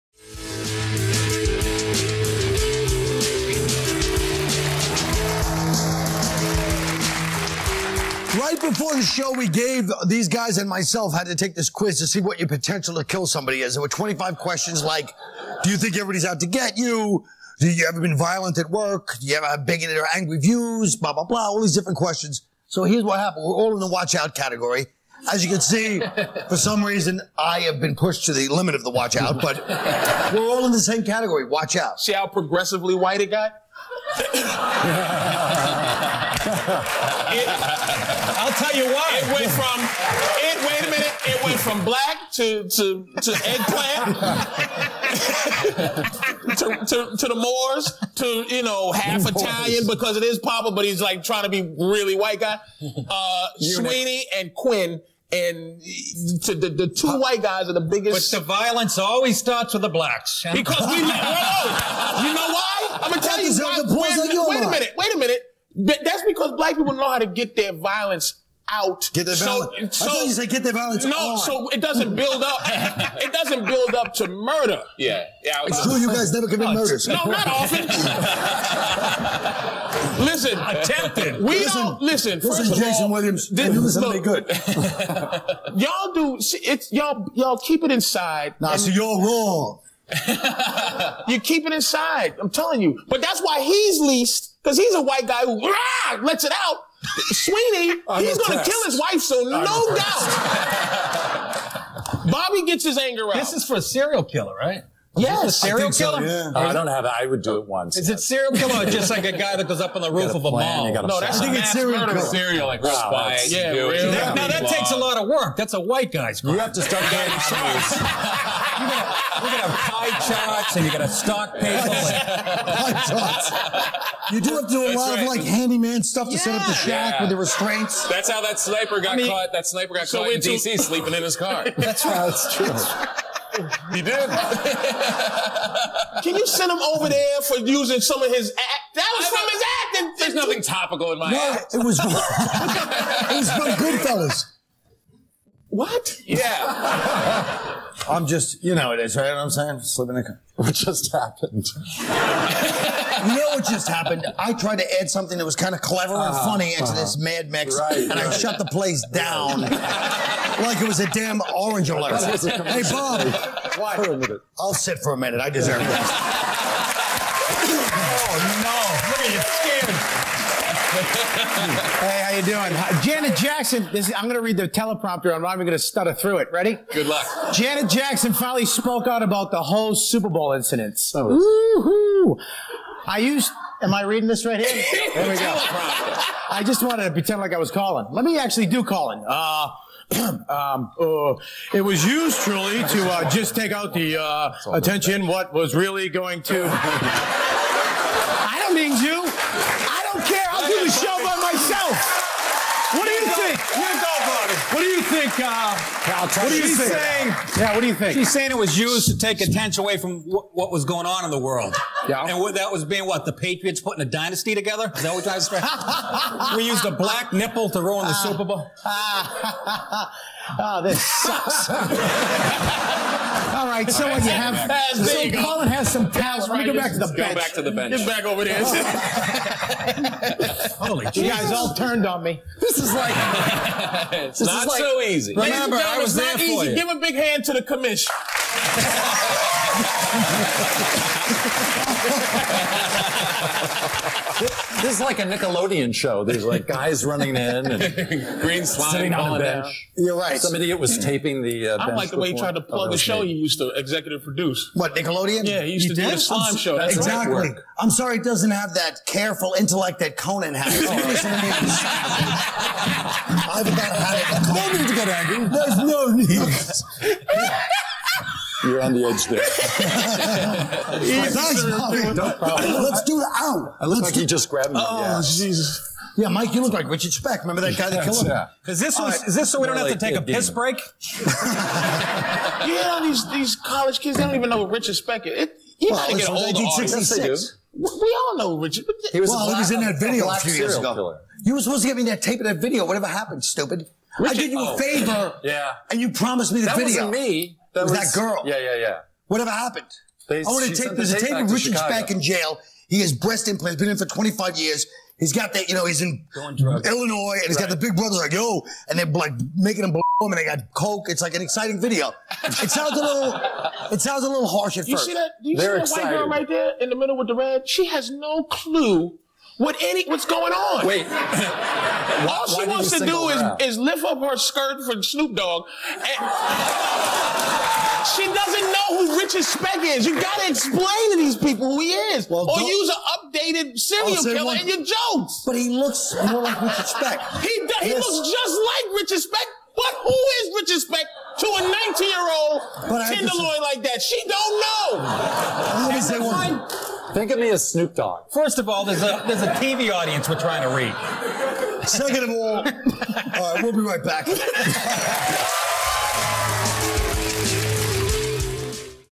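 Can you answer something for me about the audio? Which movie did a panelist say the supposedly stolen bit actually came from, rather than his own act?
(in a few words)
Goodfellas.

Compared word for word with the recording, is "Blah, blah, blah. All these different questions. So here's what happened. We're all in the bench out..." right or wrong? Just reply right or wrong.
wrong.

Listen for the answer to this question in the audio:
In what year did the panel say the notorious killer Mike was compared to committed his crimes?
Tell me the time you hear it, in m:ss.
4:46.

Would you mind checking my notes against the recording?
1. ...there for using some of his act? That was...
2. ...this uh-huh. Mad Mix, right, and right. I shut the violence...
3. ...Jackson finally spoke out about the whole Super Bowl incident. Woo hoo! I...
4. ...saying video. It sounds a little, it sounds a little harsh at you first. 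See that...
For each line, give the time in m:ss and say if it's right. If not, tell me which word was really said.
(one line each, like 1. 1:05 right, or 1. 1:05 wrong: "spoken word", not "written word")
1. 2:17 right
2. 2:36 wrong: "place", not "violence"
3. 2:57 right
4. 5:11 wrong: "exciting", not "saying".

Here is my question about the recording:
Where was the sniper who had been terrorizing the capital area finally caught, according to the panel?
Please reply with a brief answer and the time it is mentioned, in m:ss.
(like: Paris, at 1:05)
Sleeping in his car, at 2:10.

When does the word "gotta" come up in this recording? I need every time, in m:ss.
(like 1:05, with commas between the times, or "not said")
4:46, 5:30.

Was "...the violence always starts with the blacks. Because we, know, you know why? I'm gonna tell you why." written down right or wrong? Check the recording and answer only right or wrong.
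right.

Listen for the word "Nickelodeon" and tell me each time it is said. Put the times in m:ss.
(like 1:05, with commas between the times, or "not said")
4:05, 4:14.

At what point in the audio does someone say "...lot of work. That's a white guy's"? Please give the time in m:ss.
1:54.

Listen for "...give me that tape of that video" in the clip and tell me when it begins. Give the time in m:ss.
4:51.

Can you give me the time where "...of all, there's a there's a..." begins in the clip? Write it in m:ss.
5:48.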